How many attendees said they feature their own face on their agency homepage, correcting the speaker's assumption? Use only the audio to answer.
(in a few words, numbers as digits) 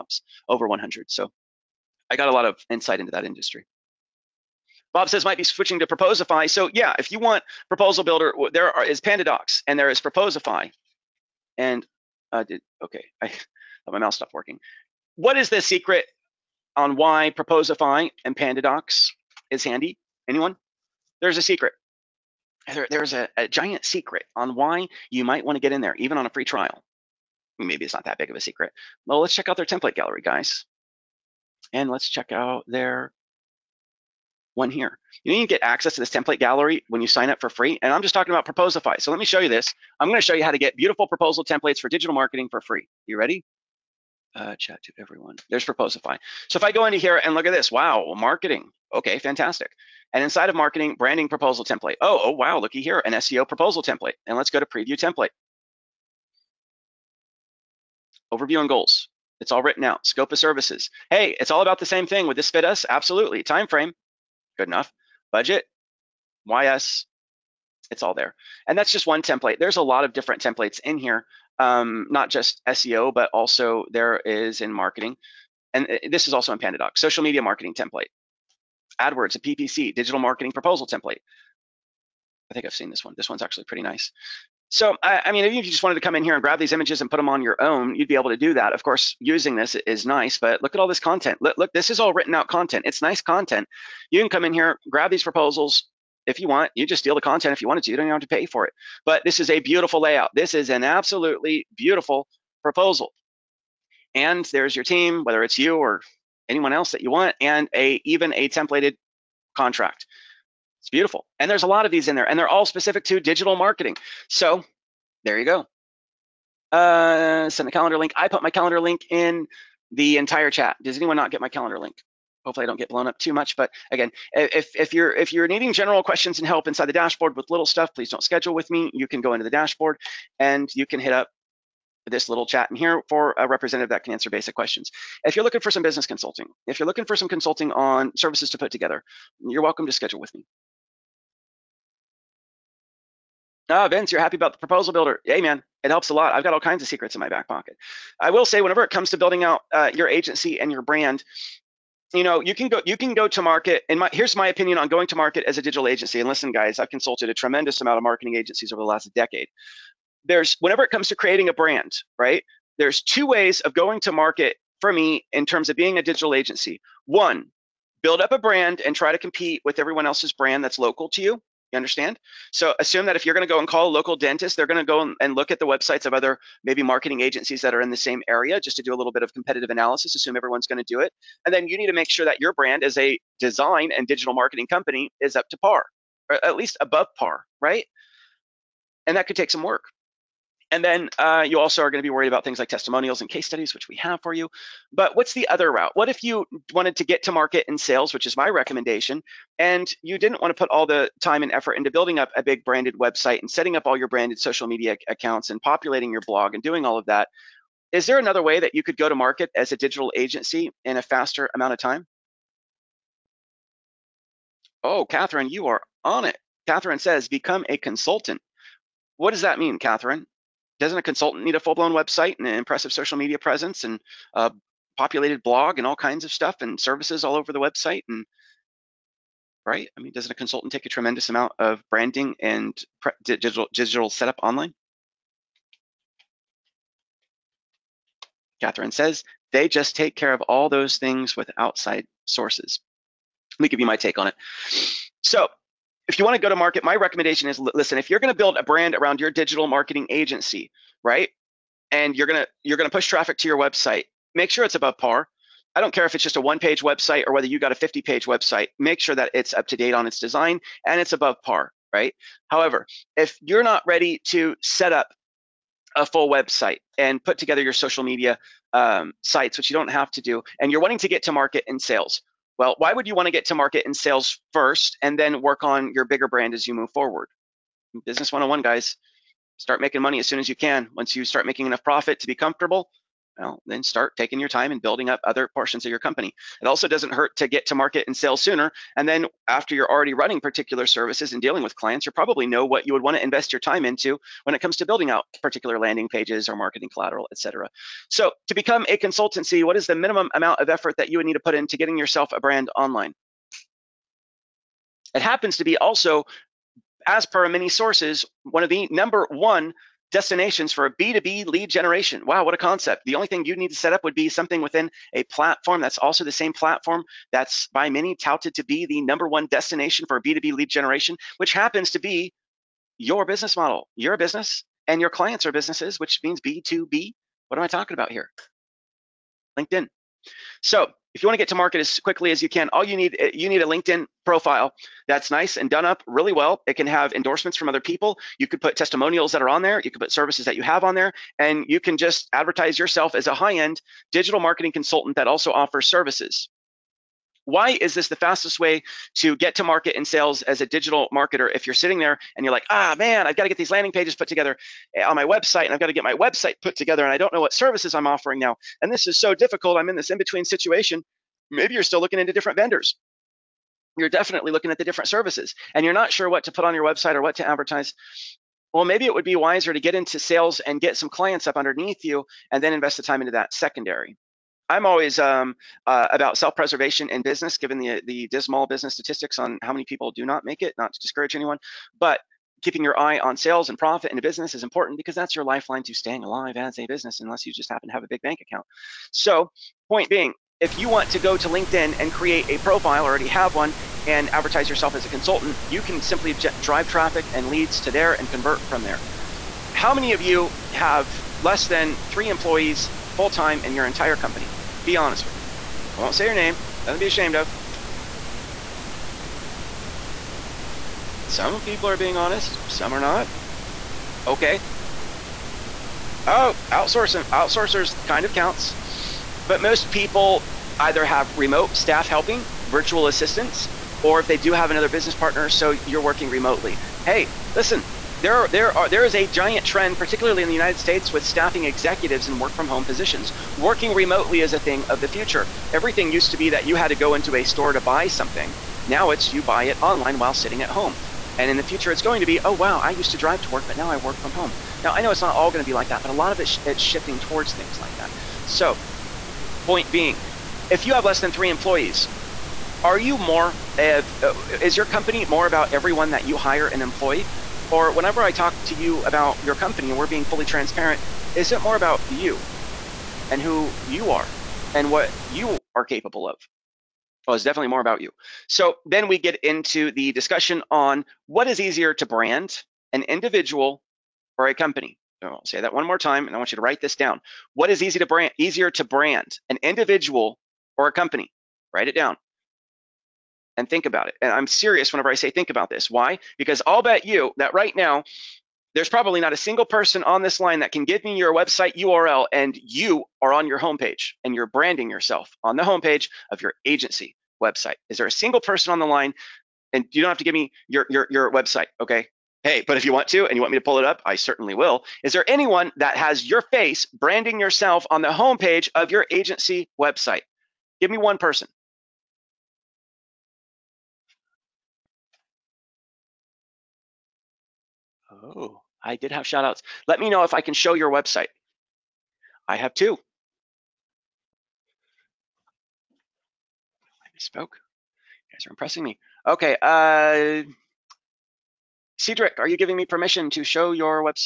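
2.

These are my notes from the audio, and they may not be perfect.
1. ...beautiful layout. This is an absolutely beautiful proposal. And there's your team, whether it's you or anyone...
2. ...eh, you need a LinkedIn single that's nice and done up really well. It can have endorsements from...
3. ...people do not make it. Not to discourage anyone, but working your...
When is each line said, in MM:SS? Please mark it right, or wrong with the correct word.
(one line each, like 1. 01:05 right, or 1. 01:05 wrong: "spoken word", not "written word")
1. 01:39 right
2. 05:33 wrong: "profile", not "single"
3. 06:19 wrong: "keeping", not "working".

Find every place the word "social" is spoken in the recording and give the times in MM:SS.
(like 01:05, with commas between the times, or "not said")
01:16, 03:24, 03:42, 04:27.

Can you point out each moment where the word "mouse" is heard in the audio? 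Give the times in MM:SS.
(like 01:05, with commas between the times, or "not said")
00:13.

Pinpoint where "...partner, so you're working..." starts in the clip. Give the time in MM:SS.
07:05.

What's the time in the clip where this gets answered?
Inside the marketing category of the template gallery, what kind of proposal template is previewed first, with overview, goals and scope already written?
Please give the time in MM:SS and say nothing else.
00:53.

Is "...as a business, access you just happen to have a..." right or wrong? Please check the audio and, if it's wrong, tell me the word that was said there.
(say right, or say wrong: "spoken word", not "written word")
wrong: "unless", not "access".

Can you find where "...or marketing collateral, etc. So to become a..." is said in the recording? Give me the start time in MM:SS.
04:56.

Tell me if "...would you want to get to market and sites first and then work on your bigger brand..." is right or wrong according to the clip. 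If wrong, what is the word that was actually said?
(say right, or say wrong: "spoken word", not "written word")
wrong: "sales", not "sites".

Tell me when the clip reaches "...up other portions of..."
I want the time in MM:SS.
04:45.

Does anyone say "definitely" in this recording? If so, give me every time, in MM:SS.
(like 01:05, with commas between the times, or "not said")
06:04, 07:47.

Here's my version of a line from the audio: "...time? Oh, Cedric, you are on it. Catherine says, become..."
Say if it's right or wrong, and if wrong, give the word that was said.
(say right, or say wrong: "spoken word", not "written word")
wrong: "Catherine", not "Cedric".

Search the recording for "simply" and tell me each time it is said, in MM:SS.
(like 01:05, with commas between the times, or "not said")
06:36.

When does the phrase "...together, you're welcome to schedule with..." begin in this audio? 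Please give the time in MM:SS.
02:18.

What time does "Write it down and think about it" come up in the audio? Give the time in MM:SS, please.
08:01.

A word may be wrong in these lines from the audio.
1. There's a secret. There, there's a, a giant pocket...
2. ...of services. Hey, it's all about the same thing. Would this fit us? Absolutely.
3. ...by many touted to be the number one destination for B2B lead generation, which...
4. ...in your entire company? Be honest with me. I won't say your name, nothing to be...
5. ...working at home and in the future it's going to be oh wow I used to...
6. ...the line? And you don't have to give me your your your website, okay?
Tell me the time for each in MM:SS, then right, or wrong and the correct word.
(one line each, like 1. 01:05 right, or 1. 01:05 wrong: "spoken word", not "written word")
1. 00:21 wrong: "secret", not "pocket"
2. 01:00 right
3. 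05:17 right
4. 06:43 right
5. 07:20 wrong: "sitting", not "working"
6. 08:18 right.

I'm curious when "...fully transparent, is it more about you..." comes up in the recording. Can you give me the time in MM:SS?
07:40.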